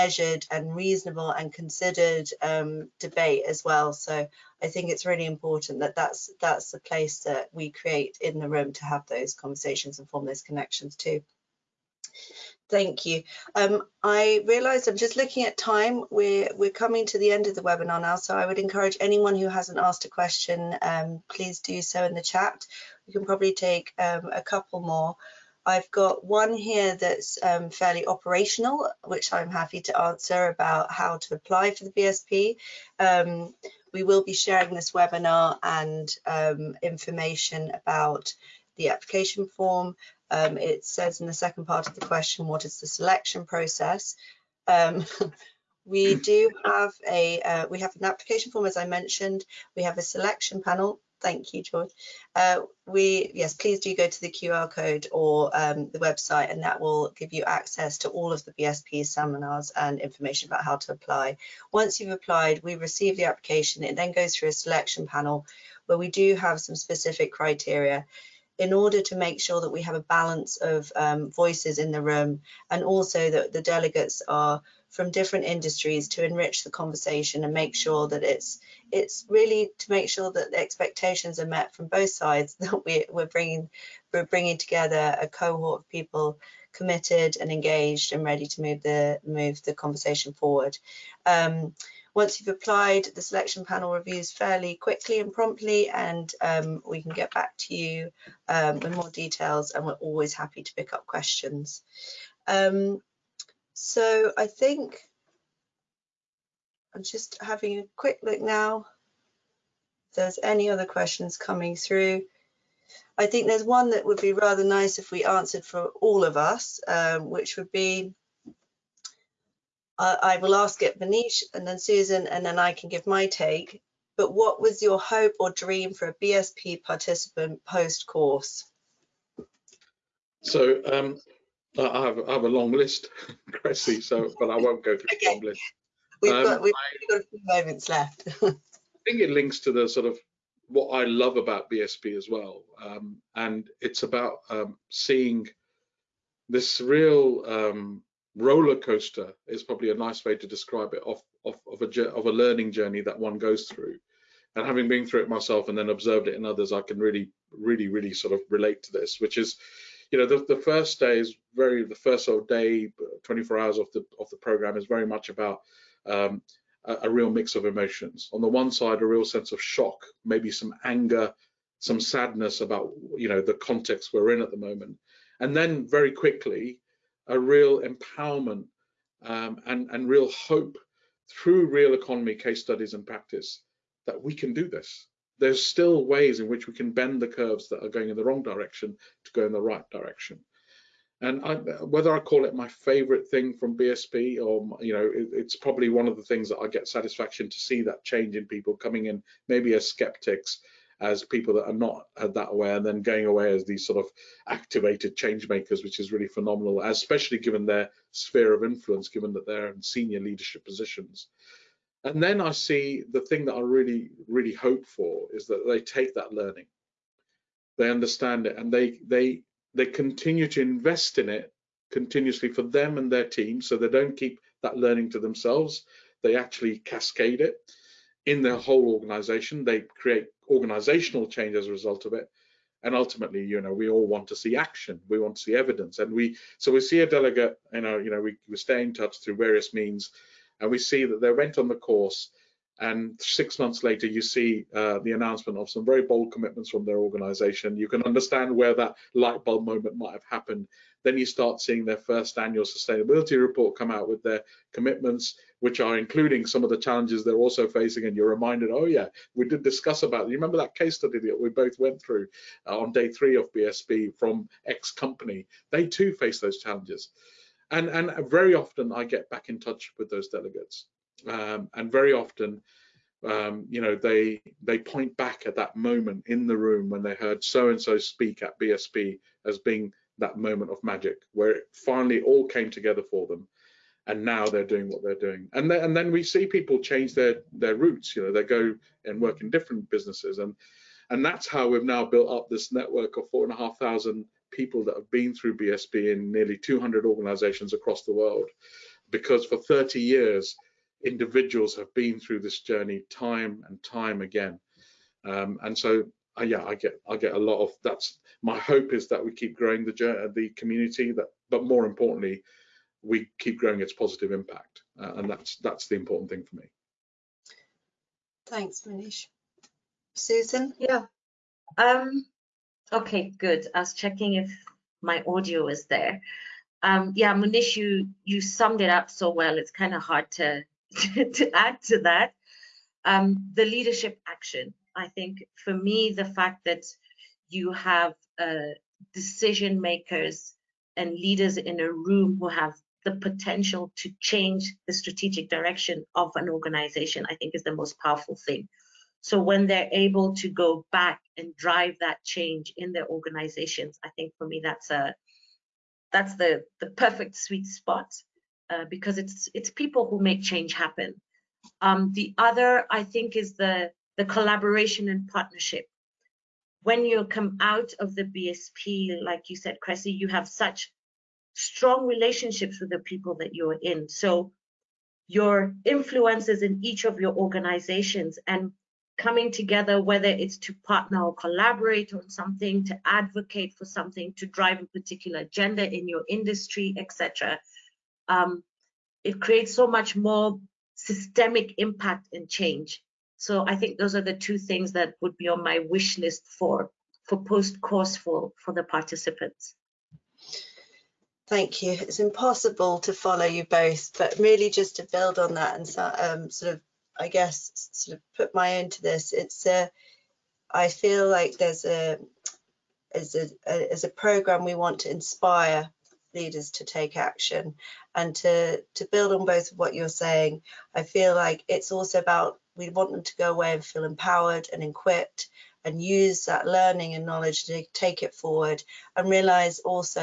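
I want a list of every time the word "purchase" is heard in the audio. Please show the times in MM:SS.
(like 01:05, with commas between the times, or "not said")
not said.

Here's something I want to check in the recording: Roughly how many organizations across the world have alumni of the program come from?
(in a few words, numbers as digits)
200.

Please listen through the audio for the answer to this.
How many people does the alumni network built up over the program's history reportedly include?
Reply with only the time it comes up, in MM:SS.
04:53.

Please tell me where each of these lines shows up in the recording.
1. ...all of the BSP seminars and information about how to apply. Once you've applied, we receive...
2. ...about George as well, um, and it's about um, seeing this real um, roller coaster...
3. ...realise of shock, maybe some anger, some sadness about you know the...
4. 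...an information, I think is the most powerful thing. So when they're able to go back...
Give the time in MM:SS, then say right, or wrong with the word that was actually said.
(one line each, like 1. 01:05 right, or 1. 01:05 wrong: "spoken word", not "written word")
1. 00:58 right
2. 02:21 wrong: "BSP", not "George"
3. 02:49 wrong: "sense", not "realise"
4. 05:46 wrong: "organization", not "information".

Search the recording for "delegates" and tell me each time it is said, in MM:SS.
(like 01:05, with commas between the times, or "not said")
01:13, 03:57, 04:30.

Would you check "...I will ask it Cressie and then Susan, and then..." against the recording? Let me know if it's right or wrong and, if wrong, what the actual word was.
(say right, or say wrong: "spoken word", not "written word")
wrong: "Munish", not "Cressie".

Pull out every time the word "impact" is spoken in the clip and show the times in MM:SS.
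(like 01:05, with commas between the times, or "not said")
05:14, 06:31.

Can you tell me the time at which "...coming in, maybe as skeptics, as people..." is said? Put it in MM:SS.
03:18.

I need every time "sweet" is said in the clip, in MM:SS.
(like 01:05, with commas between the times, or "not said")
05:57.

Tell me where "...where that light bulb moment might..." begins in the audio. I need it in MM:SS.
04:08.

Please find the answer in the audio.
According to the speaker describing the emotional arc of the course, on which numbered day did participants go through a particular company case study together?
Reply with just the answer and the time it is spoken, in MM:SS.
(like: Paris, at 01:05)
day three, at 04:22.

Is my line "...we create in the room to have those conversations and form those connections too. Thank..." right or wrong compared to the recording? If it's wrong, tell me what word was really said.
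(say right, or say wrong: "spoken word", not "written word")
right.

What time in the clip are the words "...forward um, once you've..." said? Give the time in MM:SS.
01:30.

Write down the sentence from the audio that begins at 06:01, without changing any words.
Um, the other I think is the the collaboration and partnership.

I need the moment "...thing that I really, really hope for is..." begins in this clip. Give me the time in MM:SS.
03:33.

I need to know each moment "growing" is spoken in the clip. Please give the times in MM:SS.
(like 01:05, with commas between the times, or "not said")
05:09, 05:13.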